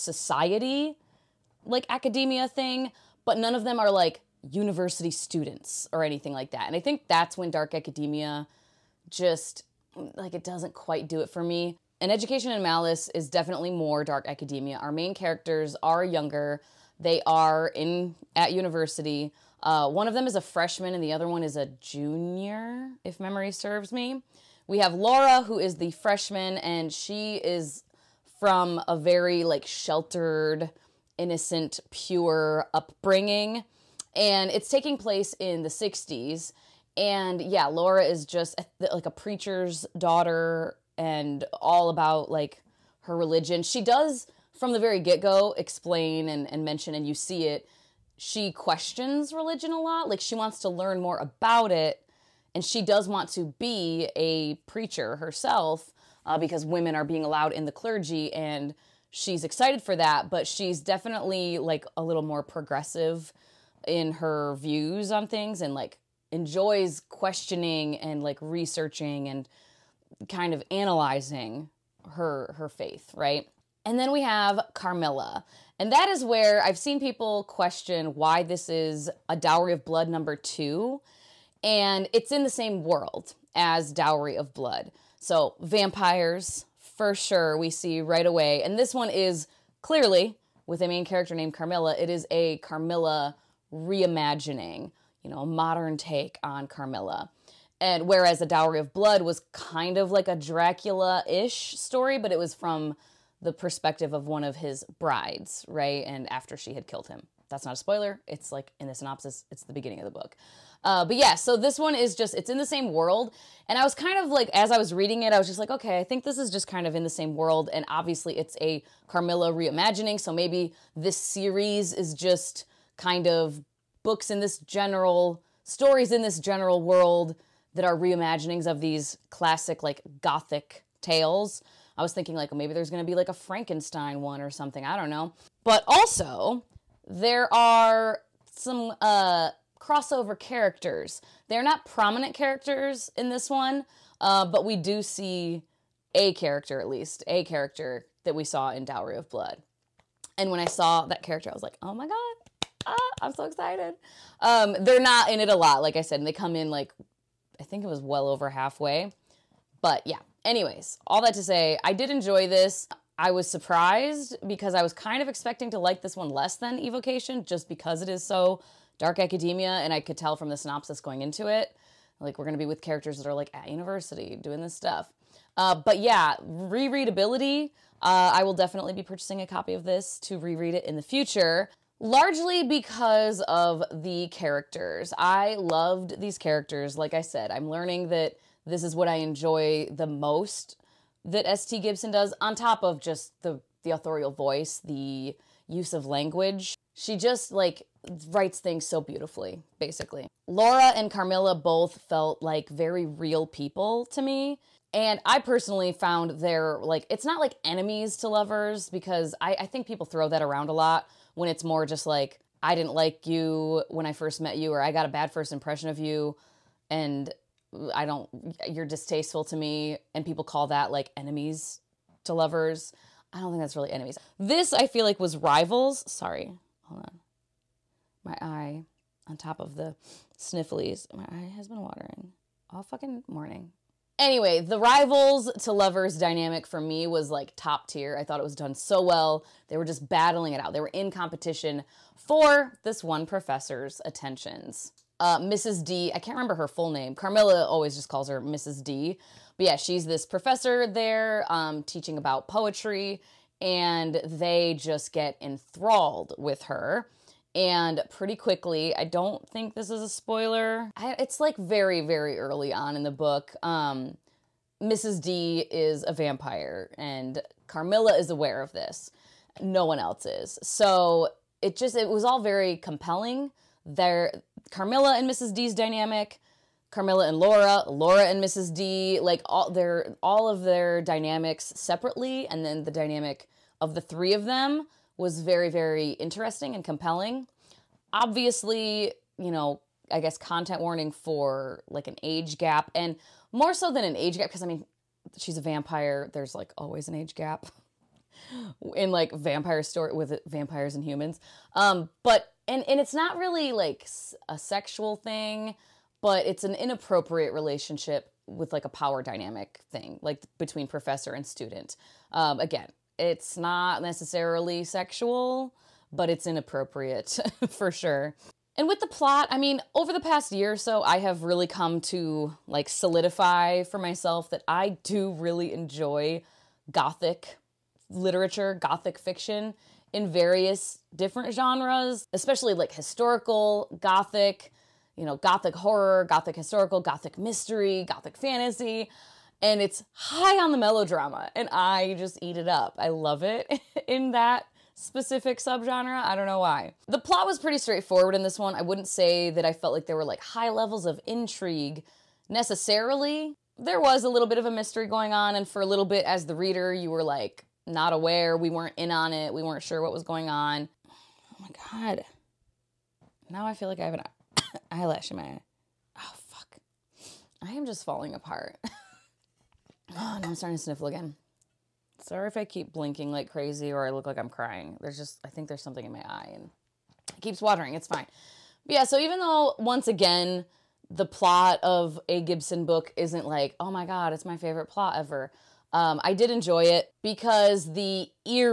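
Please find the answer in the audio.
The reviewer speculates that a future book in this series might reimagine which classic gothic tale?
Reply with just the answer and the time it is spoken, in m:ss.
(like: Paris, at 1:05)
Frankenstein, at 2:13.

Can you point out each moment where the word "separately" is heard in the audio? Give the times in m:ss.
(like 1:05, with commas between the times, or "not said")
4:41.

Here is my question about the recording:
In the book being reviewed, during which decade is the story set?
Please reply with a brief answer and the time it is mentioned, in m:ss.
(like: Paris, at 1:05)
1960s, at 0:35.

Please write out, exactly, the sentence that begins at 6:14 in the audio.
There's just, I think there's something in my eye and it keeps watering.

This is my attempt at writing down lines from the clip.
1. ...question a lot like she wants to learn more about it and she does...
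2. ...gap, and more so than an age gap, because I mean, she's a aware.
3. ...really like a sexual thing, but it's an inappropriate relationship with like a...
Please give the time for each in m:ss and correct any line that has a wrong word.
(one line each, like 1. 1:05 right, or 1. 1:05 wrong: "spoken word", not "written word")
1. 0:49 wrong: "religion", not "question"
2. 4:52 wrong: "vampire", not "aware"
3. 5:03 right.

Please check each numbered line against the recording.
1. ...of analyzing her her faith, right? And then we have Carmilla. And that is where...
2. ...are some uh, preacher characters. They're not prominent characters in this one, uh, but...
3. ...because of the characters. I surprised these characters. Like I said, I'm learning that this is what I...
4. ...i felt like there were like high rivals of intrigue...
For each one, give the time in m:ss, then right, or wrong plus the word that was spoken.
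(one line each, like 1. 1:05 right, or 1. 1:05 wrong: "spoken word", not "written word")
1. 1:10 right
2. 2:17 wrong: "crossover", not "preacher"
3. 3:02 wrong: "loved", not "surprised"
4. 5:49 wrong: "levels", not "rivals".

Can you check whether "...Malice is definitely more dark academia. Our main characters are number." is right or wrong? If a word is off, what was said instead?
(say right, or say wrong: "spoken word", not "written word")
wrong: "younger", not "number".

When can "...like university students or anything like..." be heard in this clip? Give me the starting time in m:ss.
0:03.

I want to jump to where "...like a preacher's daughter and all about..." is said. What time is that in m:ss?
0:38.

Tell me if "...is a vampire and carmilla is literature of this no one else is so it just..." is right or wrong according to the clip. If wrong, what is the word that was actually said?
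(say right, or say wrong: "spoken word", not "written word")
wrong: "aware", not "literature".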